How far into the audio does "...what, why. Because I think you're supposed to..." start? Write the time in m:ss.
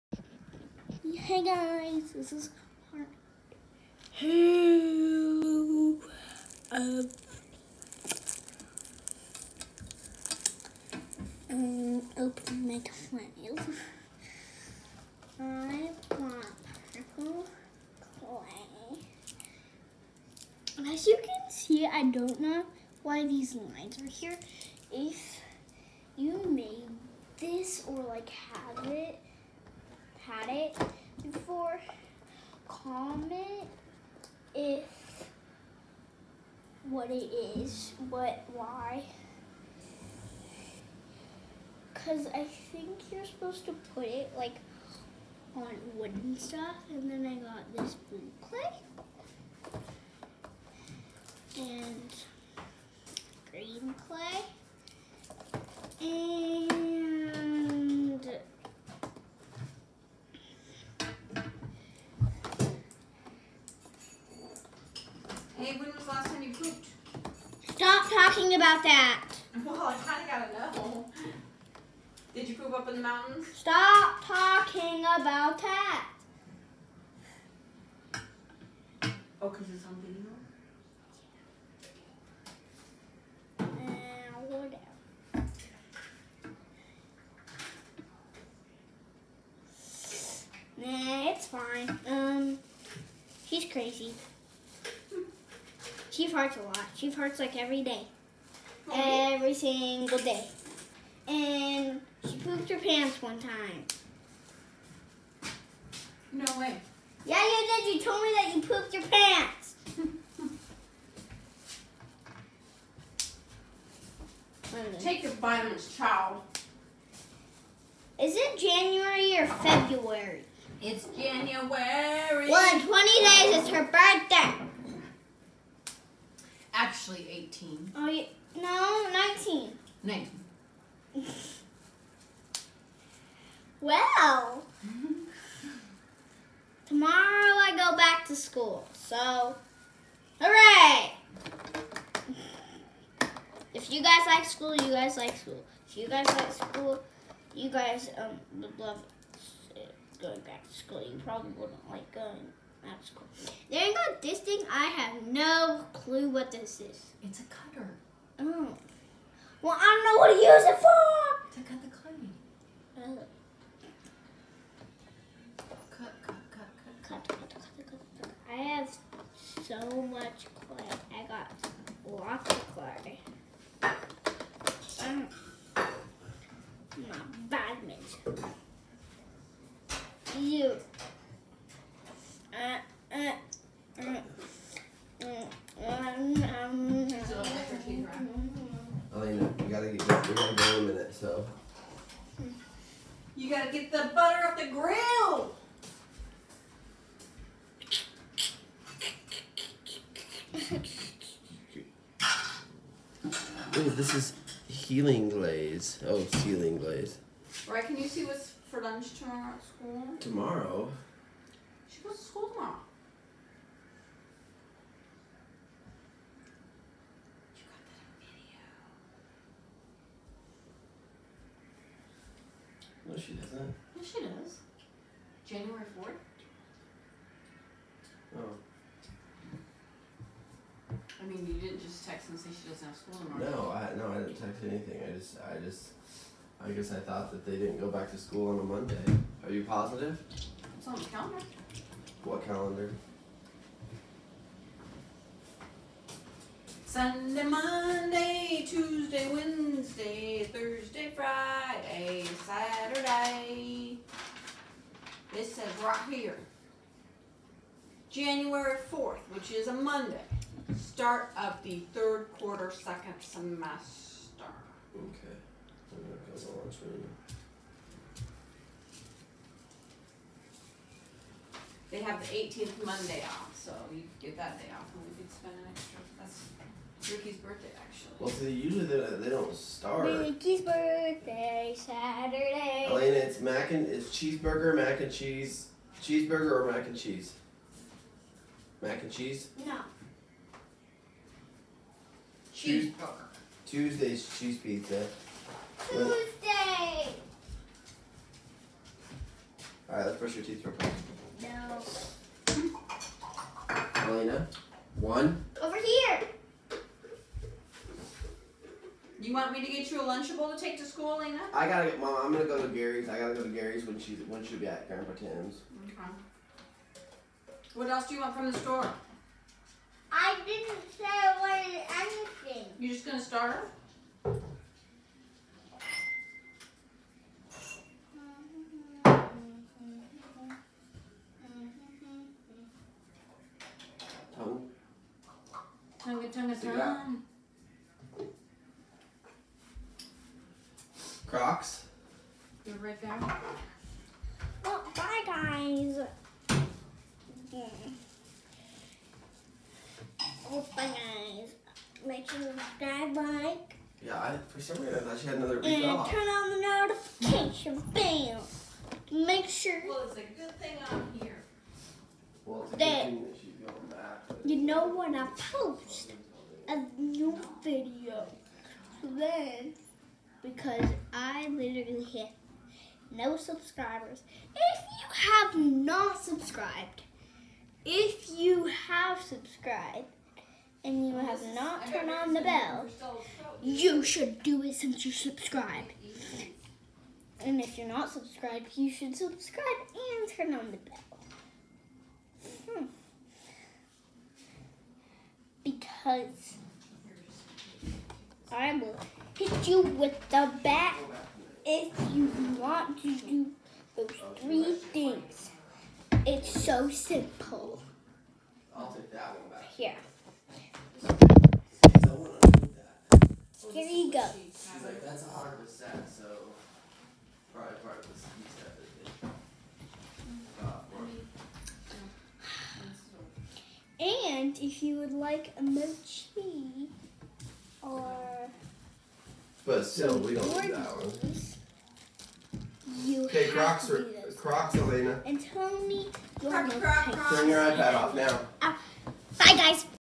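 0:38.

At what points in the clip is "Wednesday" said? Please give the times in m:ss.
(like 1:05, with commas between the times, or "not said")
4:09.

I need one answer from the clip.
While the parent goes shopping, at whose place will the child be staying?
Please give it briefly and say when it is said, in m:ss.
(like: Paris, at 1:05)
Grandpa Tim's, at 5:14.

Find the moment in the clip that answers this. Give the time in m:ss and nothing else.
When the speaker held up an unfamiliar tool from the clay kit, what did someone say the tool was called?
2:37.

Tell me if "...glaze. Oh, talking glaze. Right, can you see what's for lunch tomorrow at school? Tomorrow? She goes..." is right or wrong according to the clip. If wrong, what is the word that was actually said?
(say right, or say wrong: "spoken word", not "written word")
wrong: "healing", not "talking".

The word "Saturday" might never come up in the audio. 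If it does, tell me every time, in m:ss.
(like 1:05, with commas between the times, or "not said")
4:12, 4:41.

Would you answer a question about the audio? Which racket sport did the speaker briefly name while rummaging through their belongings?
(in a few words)
Badminton.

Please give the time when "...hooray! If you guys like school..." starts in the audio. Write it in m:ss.
2:20.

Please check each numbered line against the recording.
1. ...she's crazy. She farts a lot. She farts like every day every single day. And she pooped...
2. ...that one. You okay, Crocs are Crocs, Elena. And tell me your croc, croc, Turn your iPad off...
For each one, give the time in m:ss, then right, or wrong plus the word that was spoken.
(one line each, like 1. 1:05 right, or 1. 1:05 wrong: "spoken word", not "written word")
1. 1:33 right
2. 7:10 right.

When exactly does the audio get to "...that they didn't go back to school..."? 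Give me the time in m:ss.
3:57.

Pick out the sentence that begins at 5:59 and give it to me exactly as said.
Well, it's a good thing I'm that you know when I post a new video, then because I literally hit no subscribers.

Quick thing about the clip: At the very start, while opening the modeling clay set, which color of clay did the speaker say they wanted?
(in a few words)
Purple.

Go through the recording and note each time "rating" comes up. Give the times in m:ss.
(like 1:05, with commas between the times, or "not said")
not said.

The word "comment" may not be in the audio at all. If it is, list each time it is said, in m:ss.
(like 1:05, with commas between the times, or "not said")
0:32, 7:04.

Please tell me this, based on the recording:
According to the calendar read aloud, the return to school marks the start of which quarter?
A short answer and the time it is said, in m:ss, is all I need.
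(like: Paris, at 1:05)
Third quarter, at 4:21.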